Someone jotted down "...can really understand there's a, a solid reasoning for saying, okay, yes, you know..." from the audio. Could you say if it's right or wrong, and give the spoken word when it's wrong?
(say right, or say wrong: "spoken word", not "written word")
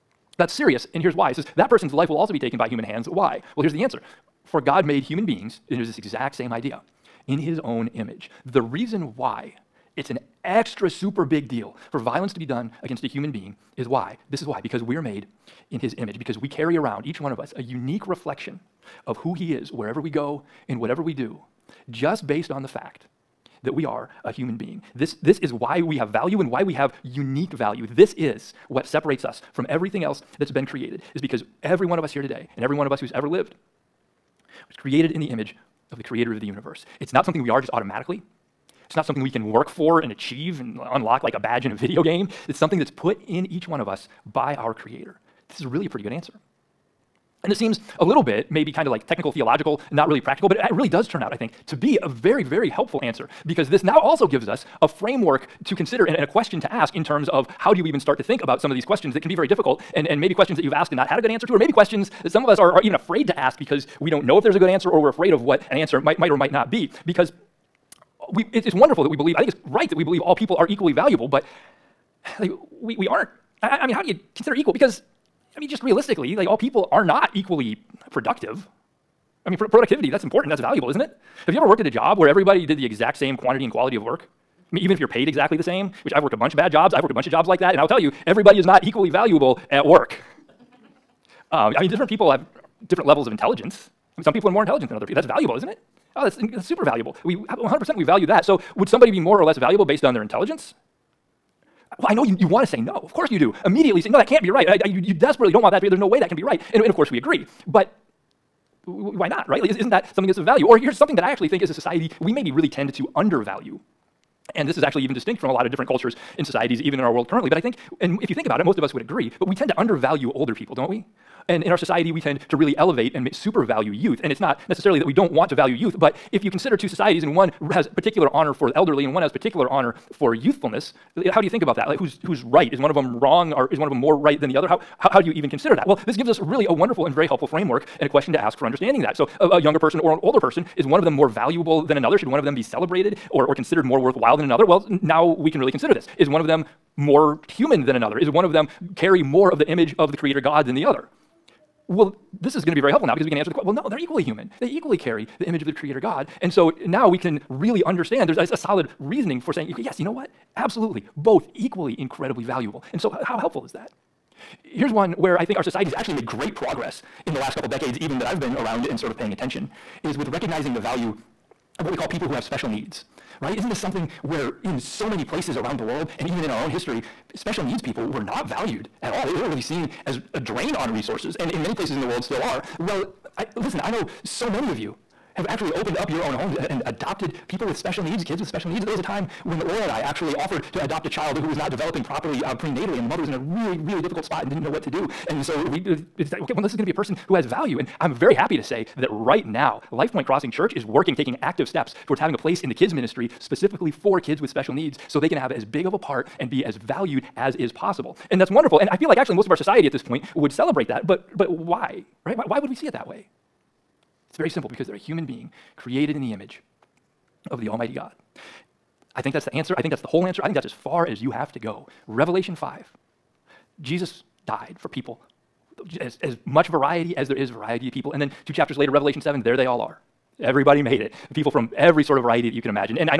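right.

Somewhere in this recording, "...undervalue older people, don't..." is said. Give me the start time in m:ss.
1:59.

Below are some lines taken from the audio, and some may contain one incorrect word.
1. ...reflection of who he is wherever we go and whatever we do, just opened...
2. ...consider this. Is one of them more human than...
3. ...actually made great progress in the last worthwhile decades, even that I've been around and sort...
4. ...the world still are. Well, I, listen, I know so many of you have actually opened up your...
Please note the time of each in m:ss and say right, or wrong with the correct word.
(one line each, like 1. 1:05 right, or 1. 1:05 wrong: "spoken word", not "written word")
1. 0:18 wrong: "based", not "opened"
2. 2:25 right
3. 2:45 wrong: "couple", not "worthwhile"
4. 3:02 right.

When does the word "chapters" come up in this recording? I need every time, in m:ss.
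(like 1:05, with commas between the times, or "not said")
3:48.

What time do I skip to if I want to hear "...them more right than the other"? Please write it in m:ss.
2:13.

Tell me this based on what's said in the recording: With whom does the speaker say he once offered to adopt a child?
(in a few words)
Laura.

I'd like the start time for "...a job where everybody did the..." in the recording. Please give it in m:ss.
1:21.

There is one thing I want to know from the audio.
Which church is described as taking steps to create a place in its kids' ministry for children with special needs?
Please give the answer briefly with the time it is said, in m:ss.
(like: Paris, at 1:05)
LifePoint Crossing Church, at 3:19.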